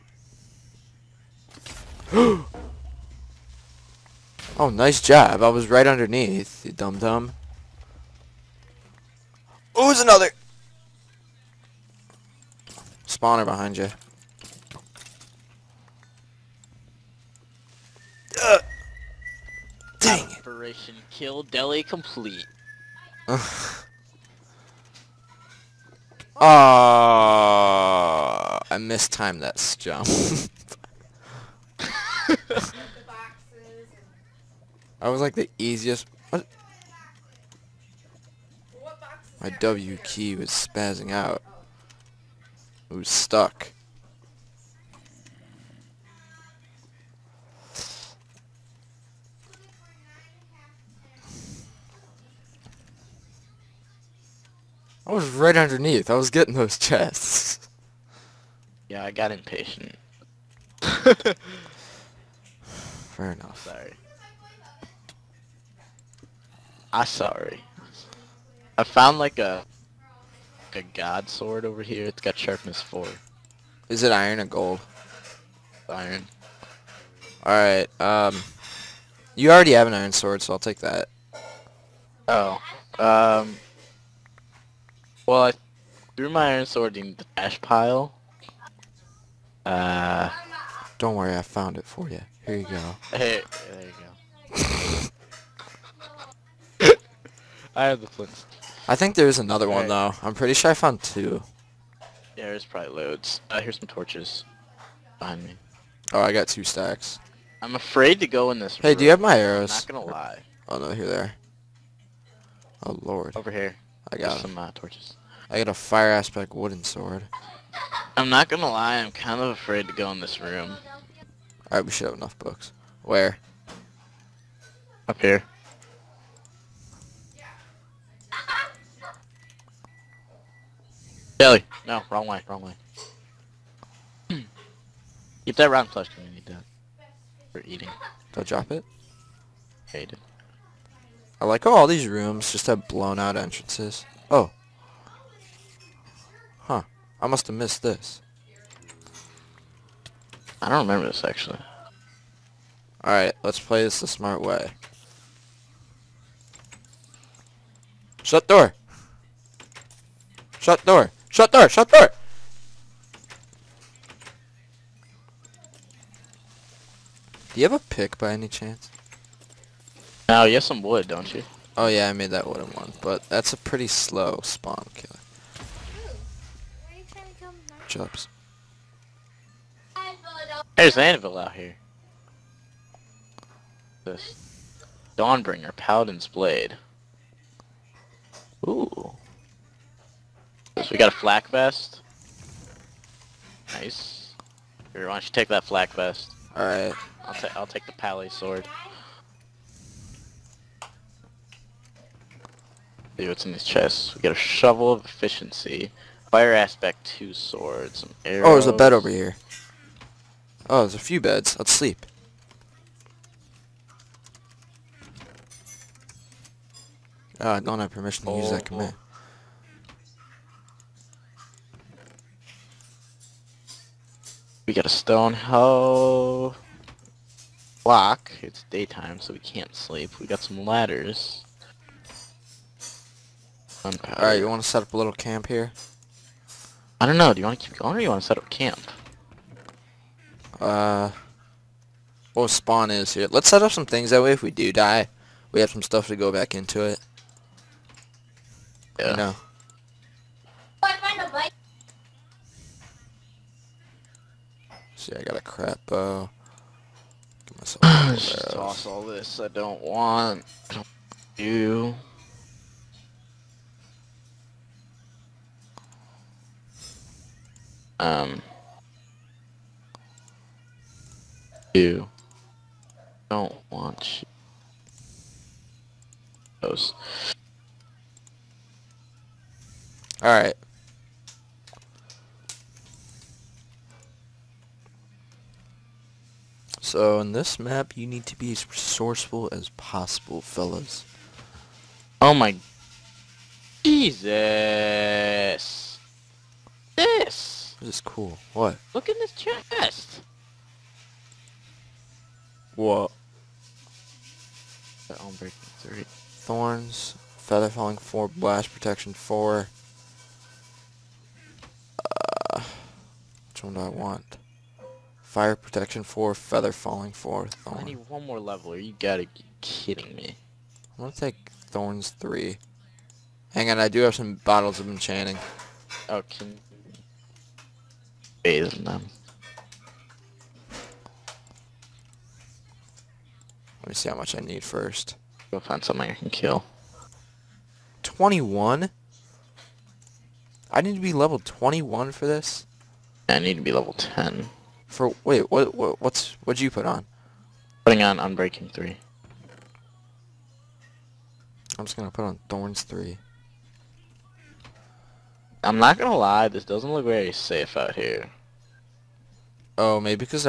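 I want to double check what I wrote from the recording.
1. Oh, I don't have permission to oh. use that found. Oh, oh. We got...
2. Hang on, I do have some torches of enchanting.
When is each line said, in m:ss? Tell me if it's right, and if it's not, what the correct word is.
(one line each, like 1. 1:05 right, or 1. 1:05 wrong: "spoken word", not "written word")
1. 3:37 wrong: "command", not "found"
2. 5:23 wrong: "bottles", not "torches".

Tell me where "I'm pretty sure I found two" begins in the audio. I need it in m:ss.
1:40.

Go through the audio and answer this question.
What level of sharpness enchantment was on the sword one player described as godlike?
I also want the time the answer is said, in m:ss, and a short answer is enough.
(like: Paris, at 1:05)
4, at 1:12.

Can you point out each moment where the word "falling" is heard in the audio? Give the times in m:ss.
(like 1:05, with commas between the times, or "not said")
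5:07, 5:16.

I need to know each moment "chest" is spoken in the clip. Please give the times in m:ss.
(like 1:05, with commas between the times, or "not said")
0:56, 3:23, 4:59.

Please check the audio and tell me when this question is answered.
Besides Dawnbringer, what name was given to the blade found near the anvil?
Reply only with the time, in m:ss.
3:05.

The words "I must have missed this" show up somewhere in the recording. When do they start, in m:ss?
2:27.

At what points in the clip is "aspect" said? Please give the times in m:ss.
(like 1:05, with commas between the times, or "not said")
1:56, 3:26.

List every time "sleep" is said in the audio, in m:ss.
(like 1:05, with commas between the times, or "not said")
3:31, 3:49.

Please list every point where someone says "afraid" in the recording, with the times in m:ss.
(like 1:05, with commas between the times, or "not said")
1:47, 1:59.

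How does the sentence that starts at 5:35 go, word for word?
Go find something I can kill.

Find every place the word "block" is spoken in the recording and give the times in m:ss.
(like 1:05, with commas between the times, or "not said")
3:47.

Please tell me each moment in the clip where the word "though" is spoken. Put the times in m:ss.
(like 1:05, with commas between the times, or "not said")
1:40.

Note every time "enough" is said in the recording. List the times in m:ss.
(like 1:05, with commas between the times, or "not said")
1:03, 2:02.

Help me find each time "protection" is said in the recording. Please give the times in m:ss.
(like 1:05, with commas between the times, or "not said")
5:08, 5:15.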